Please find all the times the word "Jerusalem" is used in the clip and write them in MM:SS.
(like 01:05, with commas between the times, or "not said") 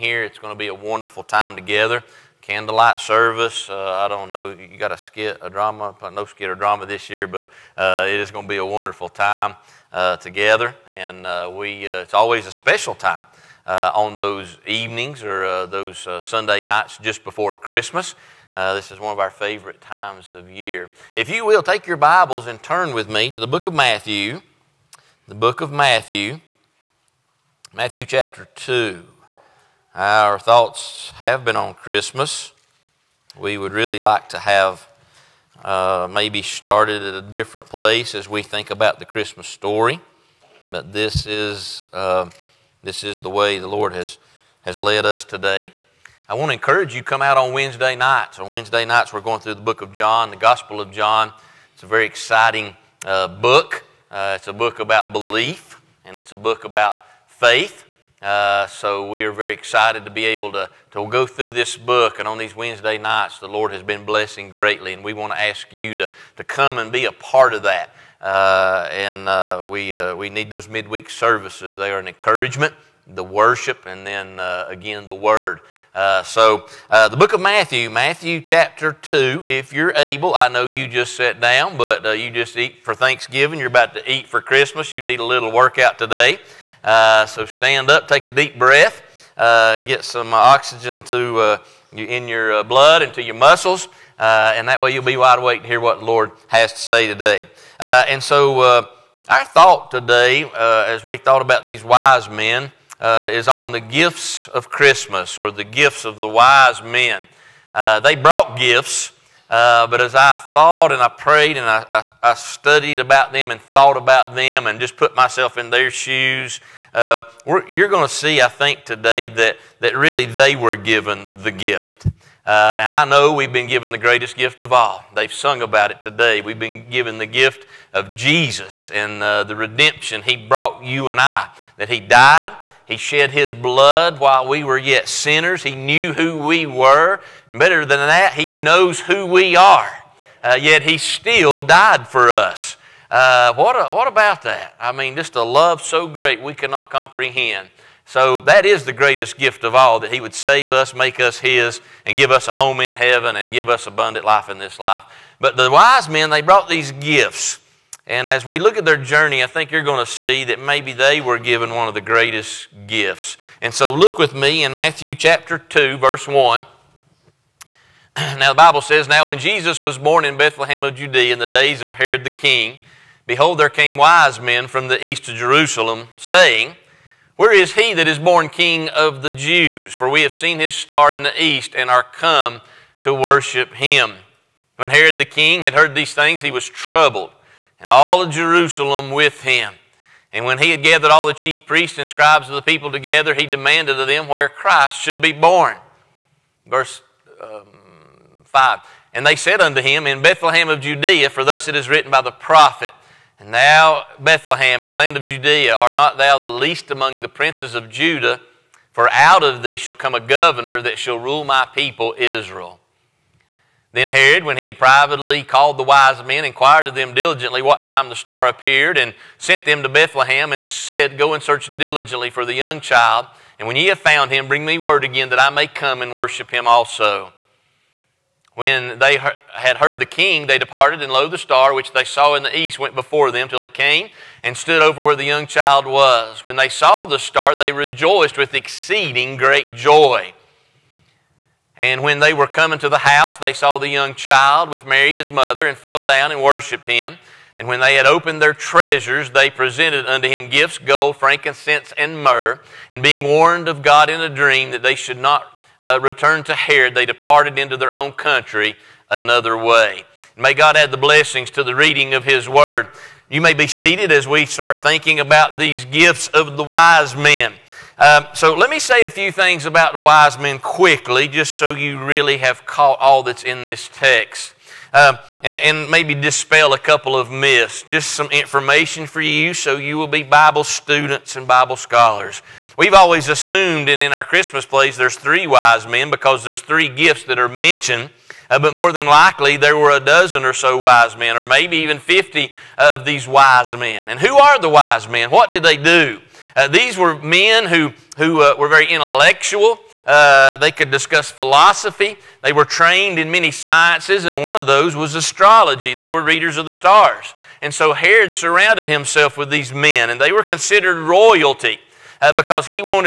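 02:55, 03:08.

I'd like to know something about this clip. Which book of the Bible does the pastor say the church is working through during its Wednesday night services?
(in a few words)
Gospel of John.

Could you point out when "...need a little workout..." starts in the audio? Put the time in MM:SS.
01:25.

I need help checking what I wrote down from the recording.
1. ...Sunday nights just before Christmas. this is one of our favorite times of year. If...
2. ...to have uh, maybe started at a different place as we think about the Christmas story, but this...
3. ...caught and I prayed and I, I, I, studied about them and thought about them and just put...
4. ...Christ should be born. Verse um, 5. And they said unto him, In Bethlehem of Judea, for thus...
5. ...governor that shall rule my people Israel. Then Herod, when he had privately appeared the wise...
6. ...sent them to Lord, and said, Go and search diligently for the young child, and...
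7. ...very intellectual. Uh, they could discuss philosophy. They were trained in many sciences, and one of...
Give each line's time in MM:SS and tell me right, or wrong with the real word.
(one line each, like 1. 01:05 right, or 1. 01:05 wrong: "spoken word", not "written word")
1. 00:16 right
2. 00:34 right
3. 01:50 wrong: "thought", not "caught"
4. 03:14 right
5. 03:30 wrong: "called", not "appeared"
6. 03:39 wrong: "Bethlehem", not "Lord"
7. 04:58 right.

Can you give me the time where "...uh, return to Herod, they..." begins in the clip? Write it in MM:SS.
04:15.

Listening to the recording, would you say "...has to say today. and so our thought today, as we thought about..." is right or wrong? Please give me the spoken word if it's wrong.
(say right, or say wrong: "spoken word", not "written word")
right.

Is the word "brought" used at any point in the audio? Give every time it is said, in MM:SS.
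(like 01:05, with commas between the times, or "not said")
01:48, 02:10, 02:36.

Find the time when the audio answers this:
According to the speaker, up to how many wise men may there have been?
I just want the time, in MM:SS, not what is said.
04:51.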